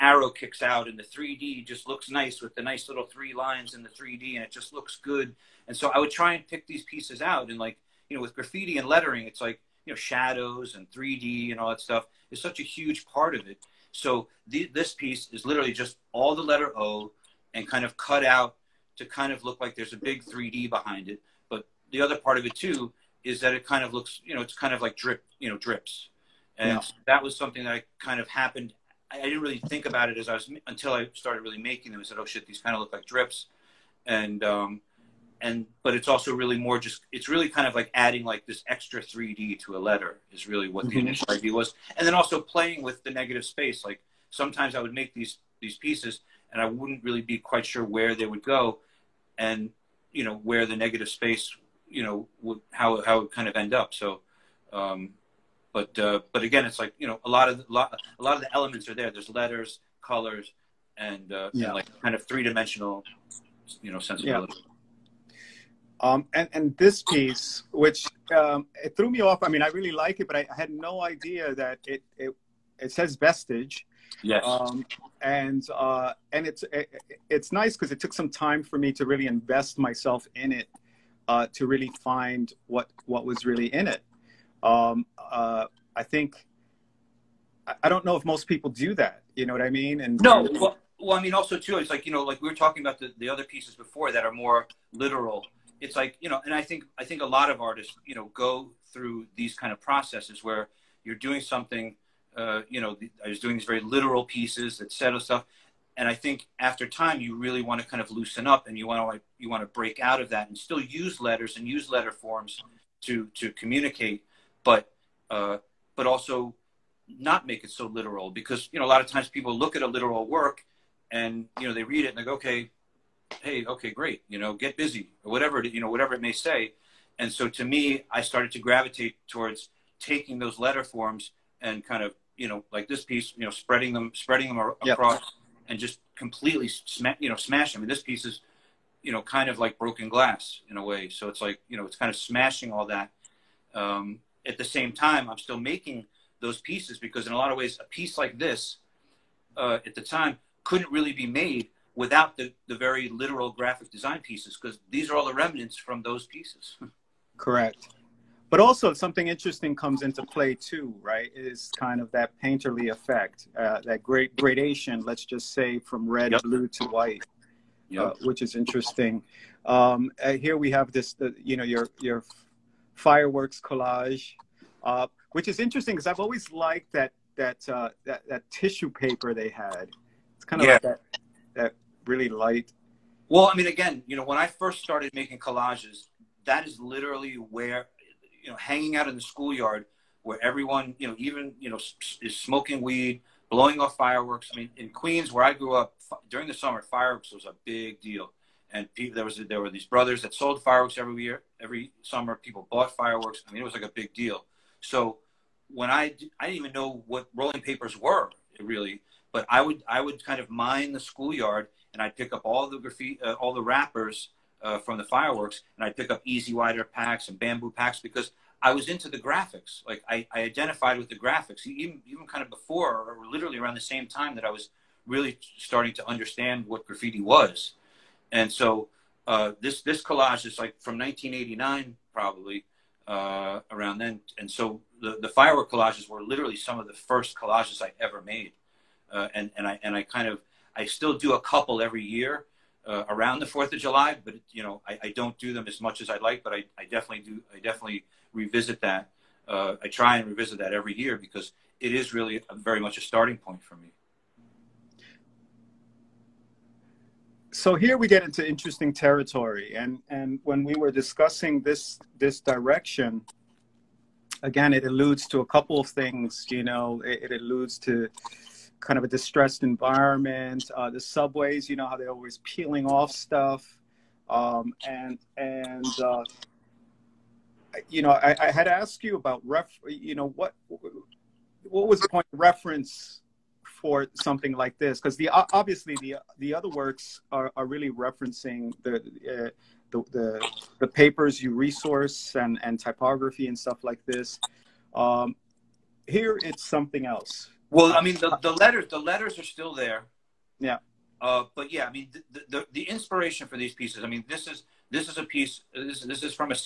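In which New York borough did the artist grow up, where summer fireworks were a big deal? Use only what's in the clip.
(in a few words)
Queens.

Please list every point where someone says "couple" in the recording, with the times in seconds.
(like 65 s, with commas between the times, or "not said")
241 s, 265 s.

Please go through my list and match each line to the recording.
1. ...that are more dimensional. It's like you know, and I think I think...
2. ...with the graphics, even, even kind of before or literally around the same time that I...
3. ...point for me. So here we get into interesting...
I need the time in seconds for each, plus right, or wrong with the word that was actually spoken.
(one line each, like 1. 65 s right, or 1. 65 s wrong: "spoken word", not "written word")
1. 94 s wrong: "literal", not "dimensional"
2. 220 s right
3. 253 s right.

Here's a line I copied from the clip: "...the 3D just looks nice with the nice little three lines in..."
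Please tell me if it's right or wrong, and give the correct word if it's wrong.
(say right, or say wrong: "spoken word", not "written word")
right.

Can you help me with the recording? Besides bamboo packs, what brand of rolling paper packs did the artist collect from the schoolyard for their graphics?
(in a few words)
E-Z Wider.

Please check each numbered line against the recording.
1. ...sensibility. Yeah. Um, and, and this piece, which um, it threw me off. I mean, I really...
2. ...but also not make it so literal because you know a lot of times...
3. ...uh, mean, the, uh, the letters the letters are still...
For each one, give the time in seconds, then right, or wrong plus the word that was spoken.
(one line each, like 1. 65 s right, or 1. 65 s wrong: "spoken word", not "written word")
1. 63 s right
2. 115 s right
3. 297 s right.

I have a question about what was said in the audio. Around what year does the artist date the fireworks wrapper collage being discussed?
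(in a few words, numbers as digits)
1989.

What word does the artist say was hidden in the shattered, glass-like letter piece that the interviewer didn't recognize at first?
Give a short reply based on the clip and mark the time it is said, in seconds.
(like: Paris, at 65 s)
Vestige, at 73 s.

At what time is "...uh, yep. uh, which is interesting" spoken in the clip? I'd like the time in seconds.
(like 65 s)
167 s.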